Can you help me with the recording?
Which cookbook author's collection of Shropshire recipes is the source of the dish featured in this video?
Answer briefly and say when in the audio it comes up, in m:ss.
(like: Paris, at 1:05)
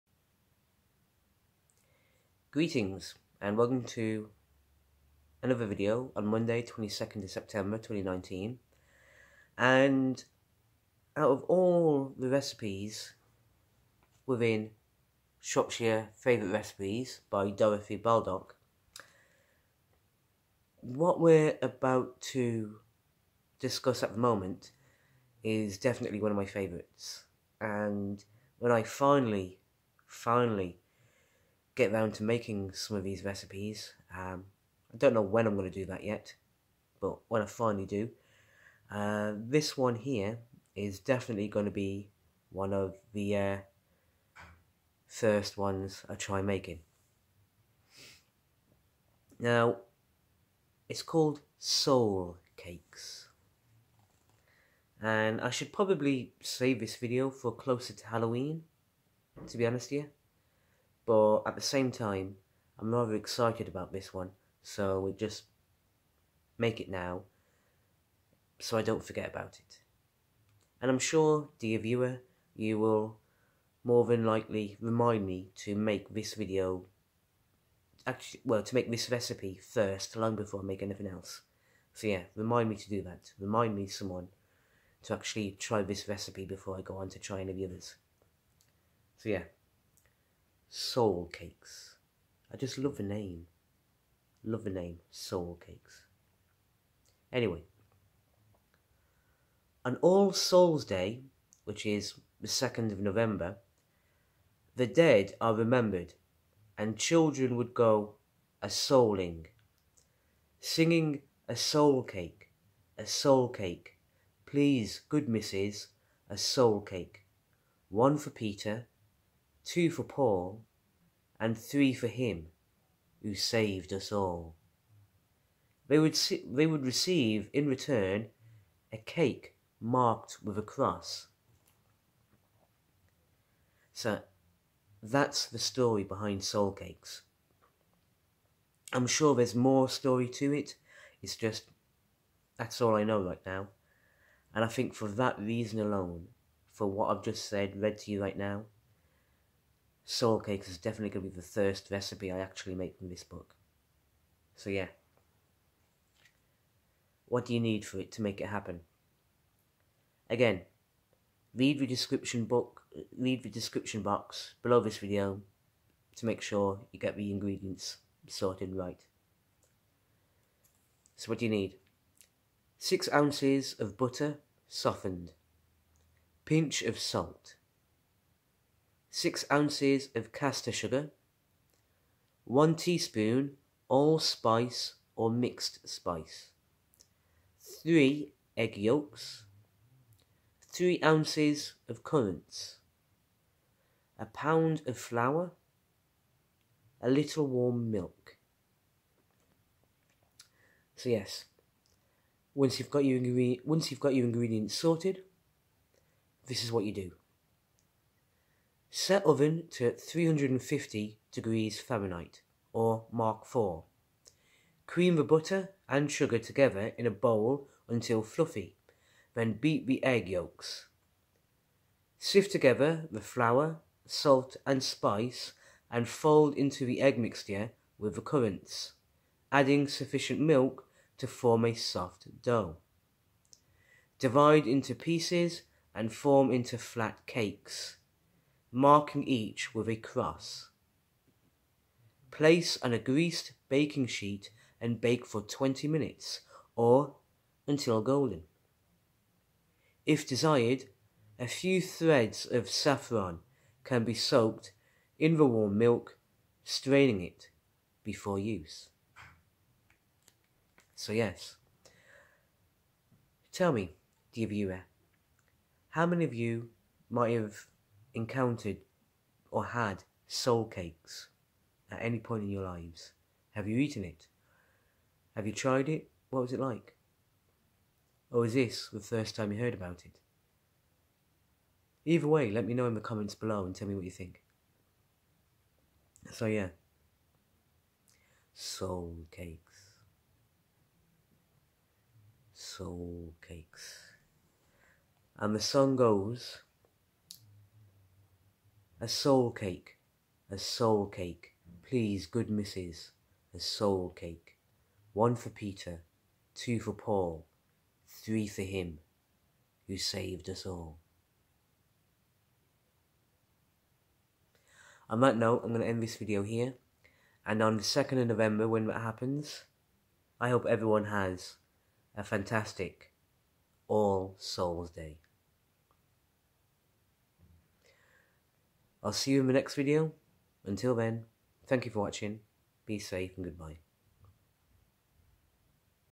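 Dorothy Baldock, at 0:17.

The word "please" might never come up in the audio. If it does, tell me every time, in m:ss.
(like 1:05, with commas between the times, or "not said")
1:54, 5:01.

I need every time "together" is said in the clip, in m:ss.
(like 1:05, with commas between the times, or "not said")
3:36, 3:42.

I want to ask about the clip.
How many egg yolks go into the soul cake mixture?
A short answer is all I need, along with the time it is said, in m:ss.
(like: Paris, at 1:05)
3, at 3:07.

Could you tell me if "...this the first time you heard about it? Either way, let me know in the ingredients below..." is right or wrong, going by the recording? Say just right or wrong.
wrong.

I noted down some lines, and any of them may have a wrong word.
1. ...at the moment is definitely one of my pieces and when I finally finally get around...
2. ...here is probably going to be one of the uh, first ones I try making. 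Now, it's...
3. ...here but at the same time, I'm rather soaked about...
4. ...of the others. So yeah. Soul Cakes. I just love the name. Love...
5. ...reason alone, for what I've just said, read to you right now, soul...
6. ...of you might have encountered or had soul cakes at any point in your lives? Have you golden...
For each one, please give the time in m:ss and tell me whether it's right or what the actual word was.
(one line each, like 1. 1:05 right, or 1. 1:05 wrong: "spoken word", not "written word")
1. 0:24 wrong: "favourites", not "pieces"
2. 0:39 wrong: "definitely", not "probably"
3. 0:59 wrong: "excited", not "soaked"
4. 1:27 right
5. 2:25 right
6. 4:26 wrong: "eaten", not "golden".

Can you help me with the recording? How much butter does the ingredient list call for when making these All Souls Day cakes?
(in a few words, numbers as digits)
6 ounces.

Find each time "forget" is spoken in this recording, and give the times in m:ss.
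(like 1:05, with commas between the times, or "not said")
1:09.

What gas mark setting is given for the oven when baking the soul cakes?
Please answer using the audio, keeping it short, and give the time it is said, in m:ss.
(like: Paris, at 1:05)
Mark Four, at 3:33.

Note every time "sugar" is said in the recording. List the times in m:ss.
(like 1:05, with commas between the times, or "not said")
3:00, 3:36.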